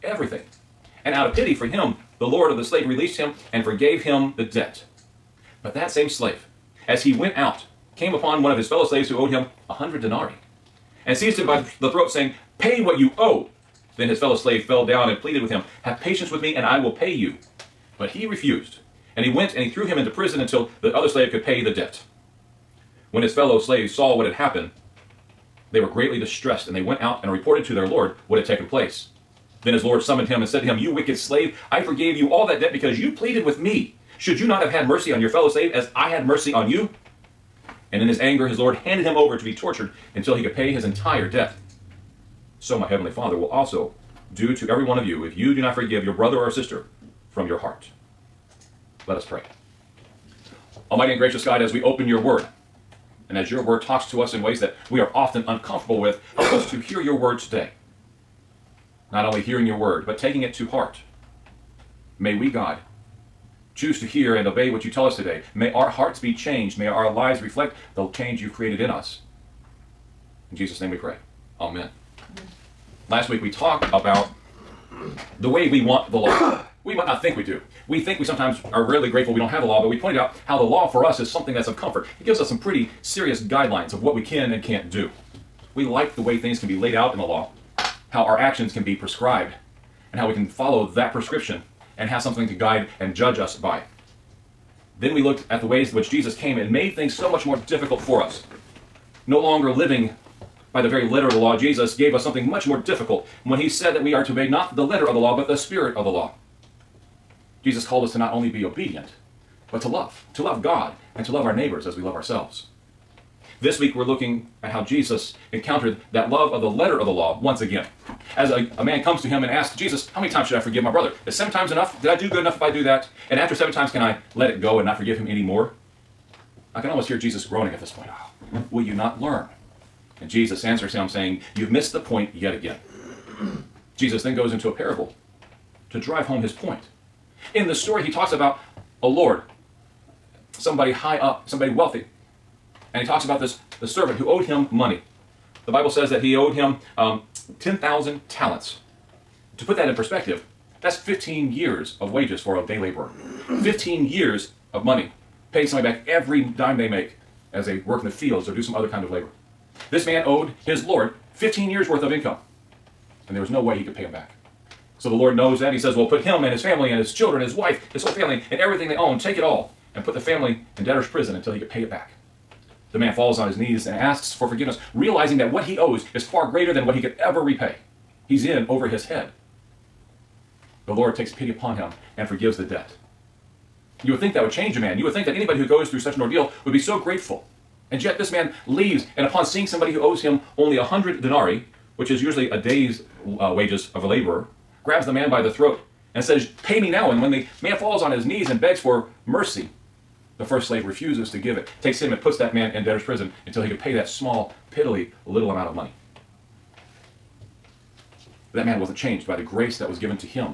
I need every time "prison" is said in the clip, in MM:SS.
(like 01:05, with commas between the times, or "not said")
00:20, 02:51, 03:23.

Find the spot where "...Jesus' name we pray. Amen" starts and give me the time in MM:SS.
01:10.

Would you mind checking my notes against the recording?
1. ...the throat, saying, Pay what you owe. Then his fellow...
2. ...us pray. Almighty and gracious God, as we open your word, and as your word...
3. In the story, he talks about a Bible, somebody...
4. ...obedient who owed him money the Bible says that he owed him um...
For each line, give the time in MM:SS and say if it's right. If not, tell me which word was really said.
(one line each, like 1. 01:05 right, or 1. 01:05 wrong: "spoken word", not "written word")
1. 00:11 right
2. 00:49 right
3. 02:17 wrong: "Lord", not "Bible"
4. 02:23 wrong: "servant", not "obedient".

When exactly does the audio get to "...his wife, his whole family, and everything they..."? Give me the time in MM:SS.
02:47.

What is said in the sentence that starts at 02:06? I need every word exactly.
I can almost hear Jesus groaning at this point.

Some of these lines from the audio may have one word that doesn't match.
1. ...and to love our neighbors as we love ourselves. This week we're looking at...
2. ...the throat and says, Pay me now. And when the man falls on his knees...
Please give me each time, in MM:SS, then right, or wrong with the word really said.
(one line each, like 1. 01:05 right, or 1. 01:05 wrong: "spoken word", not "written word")
1. 01:51 right
2. 03:15 right.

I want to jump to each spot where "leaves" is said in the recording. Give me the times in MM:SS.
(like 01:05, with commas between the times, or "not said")
03:08.